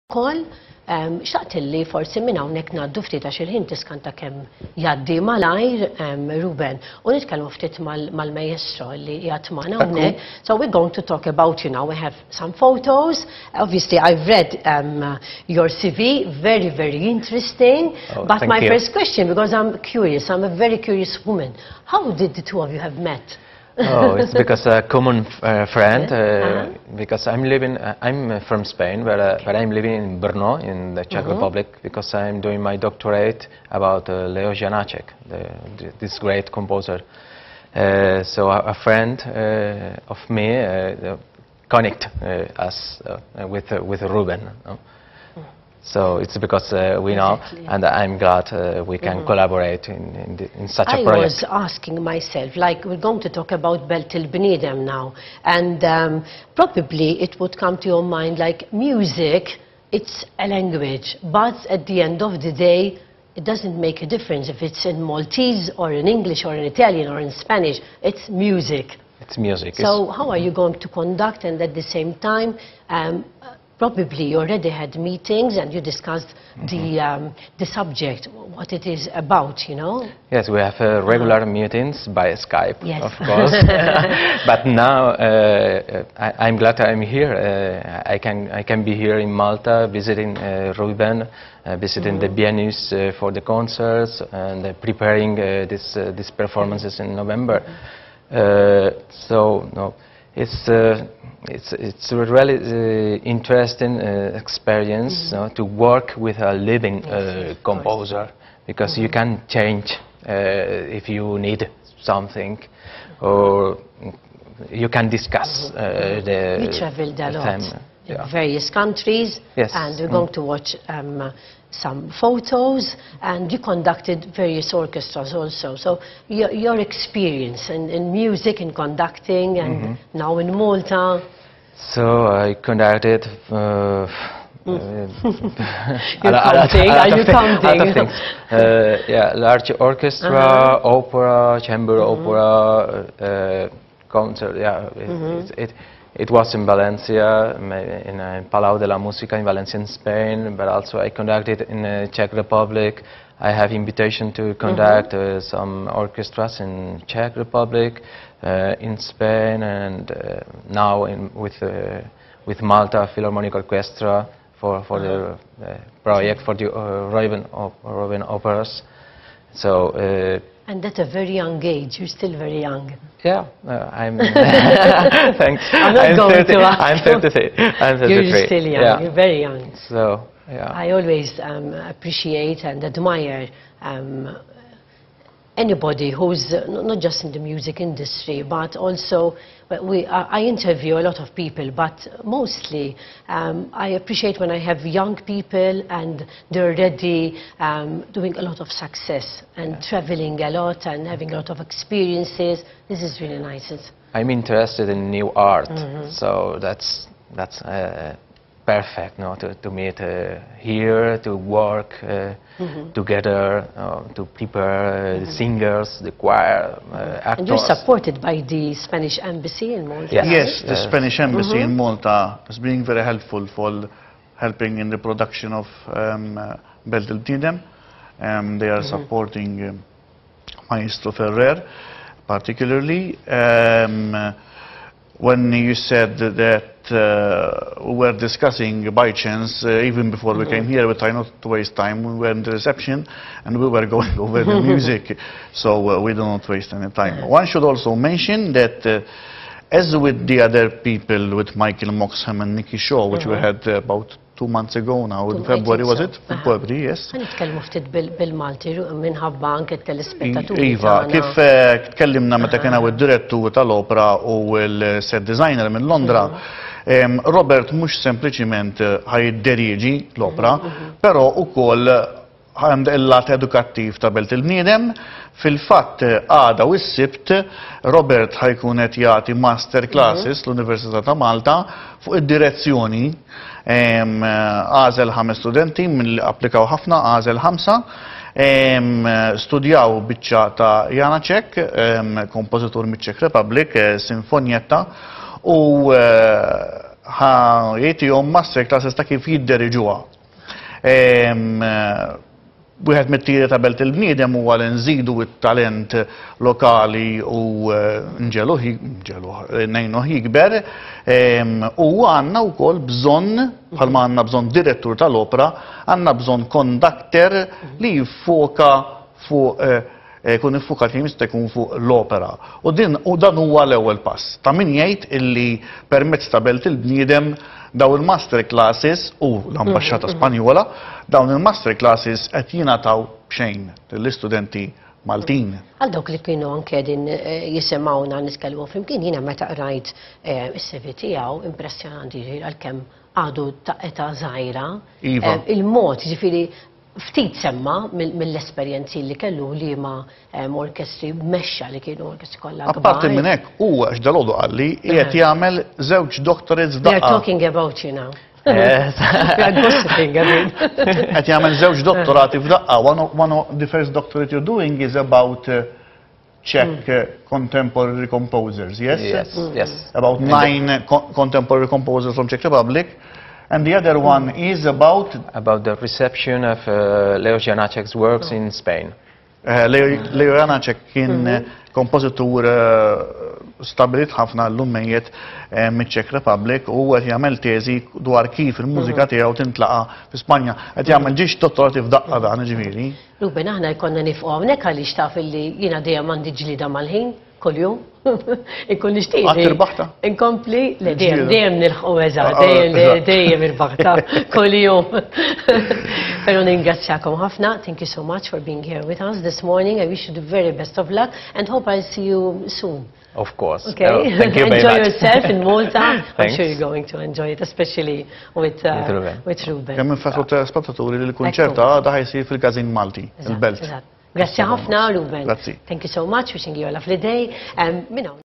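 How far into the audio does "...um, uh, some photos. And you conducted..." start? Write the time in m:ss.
2:00.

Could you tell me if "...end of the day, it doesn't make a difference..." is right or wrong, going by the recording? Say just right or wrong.
right.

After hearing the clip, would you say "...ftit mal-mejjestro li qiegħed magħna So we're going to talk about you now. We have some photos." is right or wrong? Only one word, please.
right.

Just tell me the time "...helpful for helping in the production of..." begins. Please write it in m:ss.
3:43.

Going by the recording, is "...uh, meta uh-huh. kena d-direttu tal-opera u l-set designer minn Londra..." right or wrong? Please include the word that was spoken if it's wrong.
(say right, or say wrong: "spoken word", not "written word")
right.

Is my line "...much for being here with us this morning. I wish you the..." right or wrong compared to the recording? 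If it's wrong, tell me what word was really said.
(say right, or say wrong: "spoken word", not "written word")
right.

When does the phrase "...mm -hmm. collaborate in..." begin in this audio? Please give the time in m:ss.
0:49.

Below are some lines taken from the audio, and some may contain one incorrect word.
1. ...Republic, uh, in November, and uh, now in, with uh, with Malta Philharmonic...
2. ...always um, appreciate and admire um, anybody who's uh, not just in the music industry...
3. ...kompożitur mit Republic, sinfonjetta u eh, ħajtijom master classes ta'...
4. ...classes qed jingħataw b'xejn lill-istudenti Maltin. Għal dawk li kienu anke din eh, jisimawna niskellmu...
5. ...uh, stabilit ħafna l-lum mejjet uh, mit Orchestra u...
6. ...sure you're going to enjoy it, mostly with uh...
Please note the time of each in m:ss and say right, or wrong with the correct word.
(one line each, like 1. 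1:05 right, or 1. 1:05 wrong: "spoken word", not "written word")
1. 2:37 wrong: "Spain", not "November"
2. 3:00 right
3. 4:52 right
4. 5:31 right
5. 6:22 wrong: "Republic", not "Orchestra"
6. 6:56 wrong: "especially", not "mostly".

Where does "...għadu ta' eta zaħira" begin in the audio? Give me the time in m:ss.
5:43.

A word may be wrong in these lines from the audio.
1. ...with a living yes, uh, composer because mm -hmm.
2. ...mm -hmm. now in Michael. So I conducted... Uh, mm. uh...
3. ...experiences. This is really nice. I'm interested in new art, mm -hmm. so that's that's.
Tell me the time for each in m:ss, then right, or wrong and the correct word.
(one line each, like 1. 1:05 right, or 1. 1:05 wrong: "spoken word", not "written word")
1. 1:46 right
2. 2:09 wrong: "Malta", not "Michael"
3. 3:21 right.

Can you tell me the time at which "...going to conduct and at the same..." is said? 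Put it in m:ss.
1:10.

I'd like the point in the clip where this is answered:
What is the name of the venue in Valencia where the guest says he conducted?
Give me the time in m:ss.
2:28.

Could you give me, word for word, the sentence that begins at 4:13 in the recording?
had uh, about two months ago now, in February, was it?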